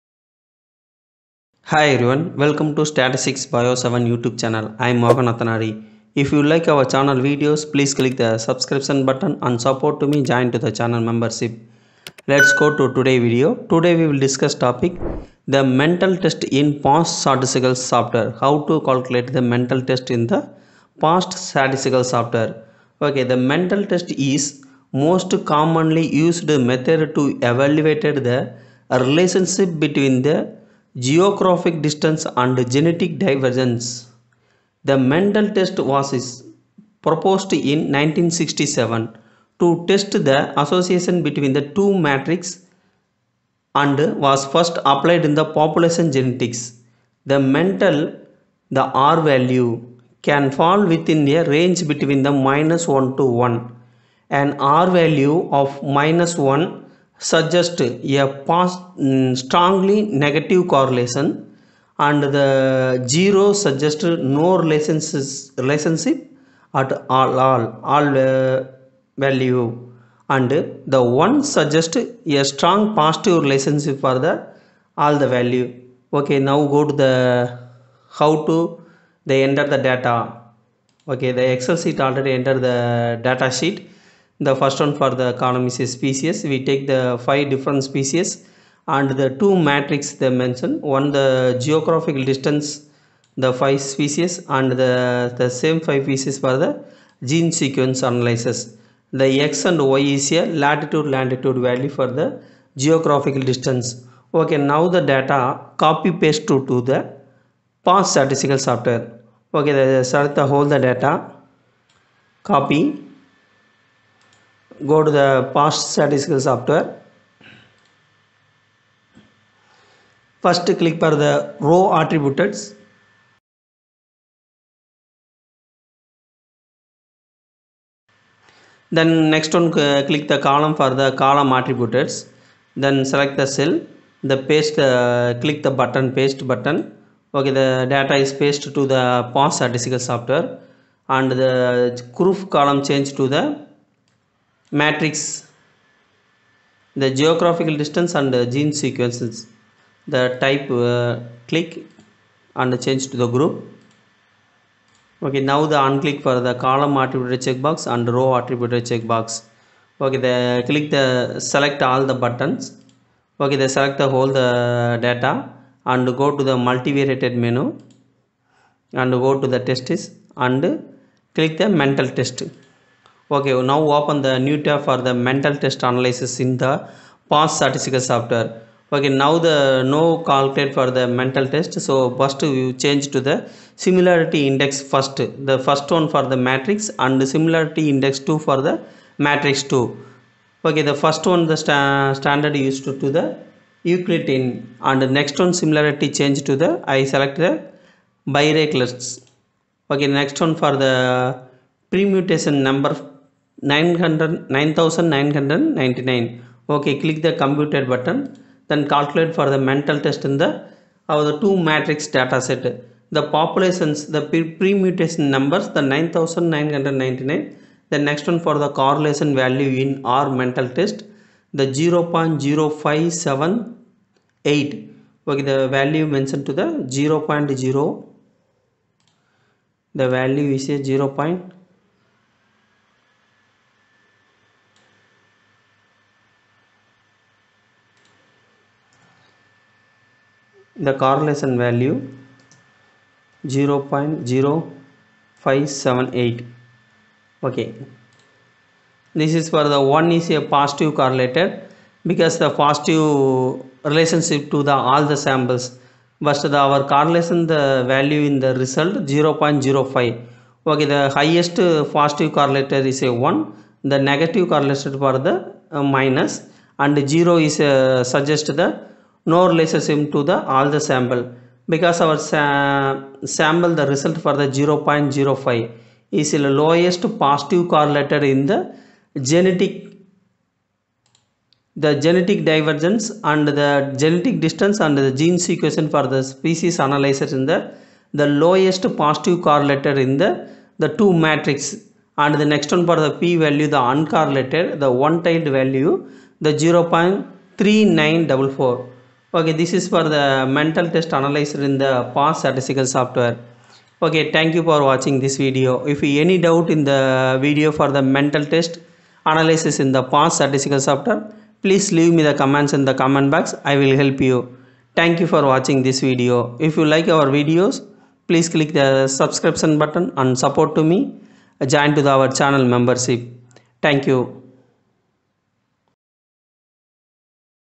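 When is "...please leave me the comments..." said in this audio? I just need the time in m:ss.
5:11.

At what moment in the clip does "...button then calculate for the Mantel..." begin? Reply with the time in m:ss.
3:27.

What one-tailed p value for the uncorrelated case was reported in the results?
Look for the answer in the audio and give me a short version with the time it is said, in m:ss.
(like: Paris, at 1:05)
0.3944, at 4:56.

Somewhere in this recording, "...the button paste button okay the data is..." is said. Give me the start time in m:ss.
2:15.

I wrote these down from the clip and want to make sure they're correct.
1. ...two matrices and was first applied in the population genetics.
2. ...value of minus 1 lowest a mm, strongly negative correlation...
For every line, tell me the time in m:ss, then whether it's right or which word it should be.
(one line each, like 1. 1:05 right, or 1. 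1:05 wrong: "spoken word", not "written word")
1. 0:41 right
2. 0:54 wrong: "suggest", not "lowest".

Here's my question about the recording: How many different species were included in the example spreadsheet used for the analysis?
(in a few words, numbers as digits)
5.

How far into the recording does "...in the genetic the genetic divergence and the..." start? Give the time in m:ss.
4:38.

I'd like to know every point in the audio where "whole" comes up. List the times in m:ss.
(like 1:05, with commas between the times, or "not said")
1:50, 2:44.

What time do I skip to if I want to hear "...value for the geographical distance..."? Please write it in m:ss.
1:41.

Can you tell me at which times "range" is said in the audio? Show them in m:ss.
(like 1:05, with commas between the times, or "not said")
0:51.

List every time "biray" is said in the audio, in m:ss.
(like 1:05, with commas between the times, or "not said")
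3:18.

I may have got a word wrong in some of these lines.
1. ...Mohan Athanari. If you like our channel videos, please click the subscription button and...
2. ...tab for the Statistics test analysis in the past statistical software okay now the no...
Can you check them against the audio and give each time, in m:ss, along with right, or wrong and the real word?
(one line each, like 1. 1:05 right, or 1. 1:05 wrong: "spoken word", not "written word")
1. 0:04 right
2. 2:54 wrong: "Mantel", not "Statistics".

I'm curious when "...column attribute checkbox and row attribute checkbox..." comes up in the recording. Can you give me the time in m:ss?
2:36.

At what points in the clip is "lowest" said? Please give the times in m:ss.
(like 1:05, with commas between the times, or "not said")
4:36, 4:48.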